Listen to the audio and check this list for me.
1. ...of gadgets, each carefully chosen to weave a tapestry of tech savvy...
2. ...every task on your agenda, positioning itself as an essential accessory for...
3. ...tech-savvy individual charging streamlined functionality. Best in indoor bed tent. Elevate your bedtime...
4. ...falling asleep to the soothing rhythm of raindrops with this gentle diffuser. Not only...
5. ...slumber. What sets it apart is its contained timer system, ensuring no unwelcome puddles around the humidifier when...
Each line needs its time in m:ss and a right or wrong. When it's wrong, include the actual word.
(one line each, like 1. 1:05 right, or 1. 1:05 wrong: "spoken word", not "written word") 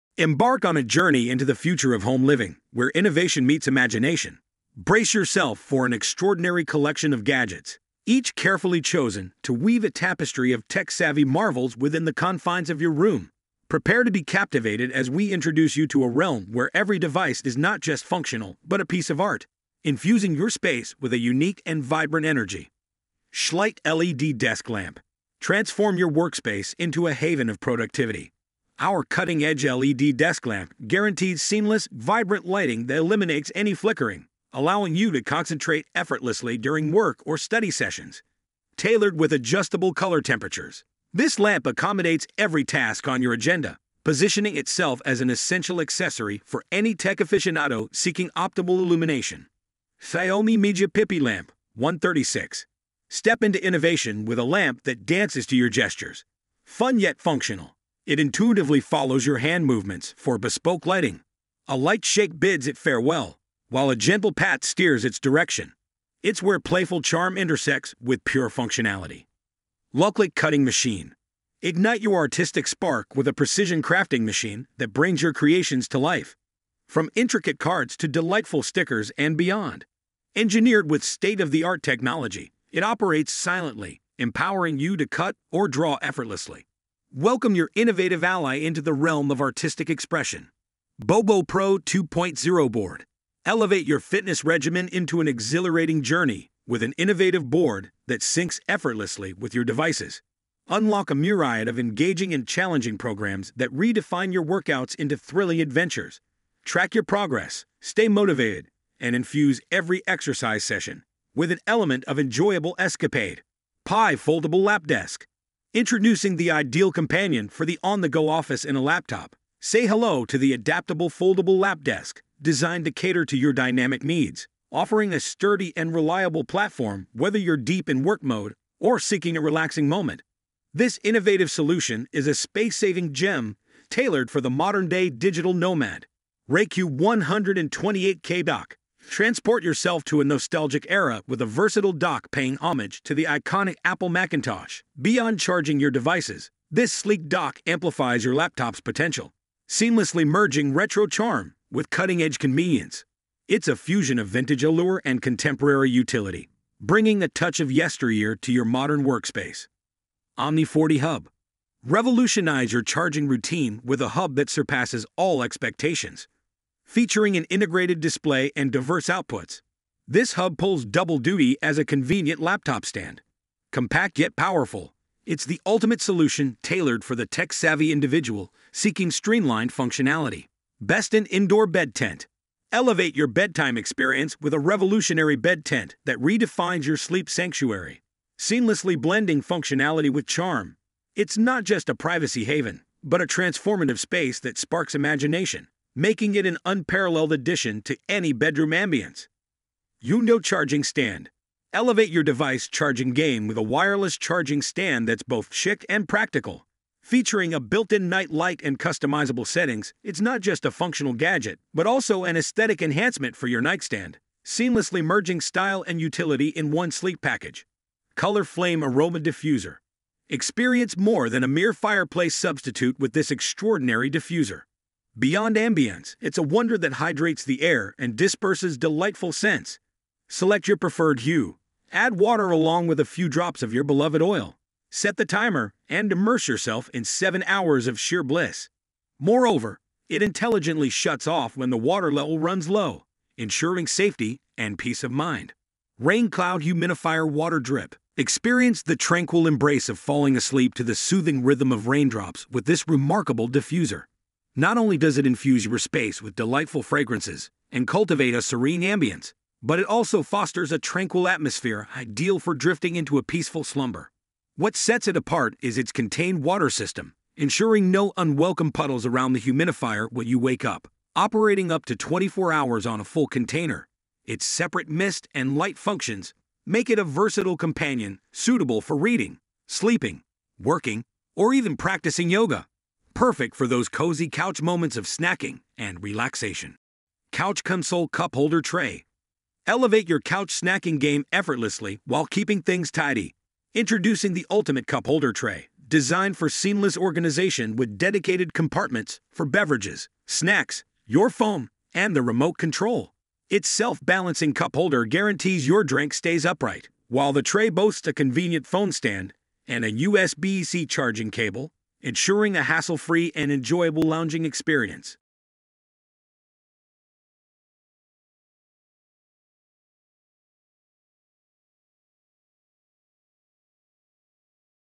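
1. 0:07 right
2. 0:42 right
3. 2:57 wrong: "seeking", not "charging"
4. 4:09 wrong: "remarkable", not "gentle"
5. 4:23 wrong: "water", not "timer".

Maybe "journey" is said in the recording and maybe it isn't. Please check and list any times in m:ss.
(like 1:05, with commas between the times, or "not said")
0:00, 1:36.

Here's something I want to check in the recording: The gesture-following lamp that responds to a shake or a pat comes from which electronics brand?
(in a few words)
Xiaomi.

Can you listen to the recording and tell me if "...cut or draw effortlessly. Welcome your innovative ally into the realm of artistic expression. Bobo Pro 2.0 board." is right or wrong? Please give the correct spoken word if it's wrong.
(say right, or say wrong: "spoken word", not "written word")
right.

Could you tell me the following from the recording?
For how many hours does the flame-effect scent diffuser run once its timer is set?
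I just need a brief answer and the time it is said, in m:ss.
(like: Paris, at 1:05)
7, at 3:57.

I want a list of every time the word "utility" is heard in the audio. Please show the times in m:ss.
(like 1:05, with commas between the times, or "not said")
2:35, 3:35.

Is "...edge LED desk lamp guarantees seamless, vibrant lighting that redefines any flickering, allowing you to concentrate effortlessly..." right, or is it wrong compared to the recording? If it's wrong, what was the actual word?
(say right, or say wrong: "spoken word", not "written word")
wrong: "eliminates", not "redefines".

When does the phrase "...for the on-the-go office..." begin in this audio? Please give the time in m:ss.
1:57.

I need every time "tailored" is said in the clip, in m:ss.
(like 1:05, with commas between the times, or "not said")
0:38, 2:13, 2:56.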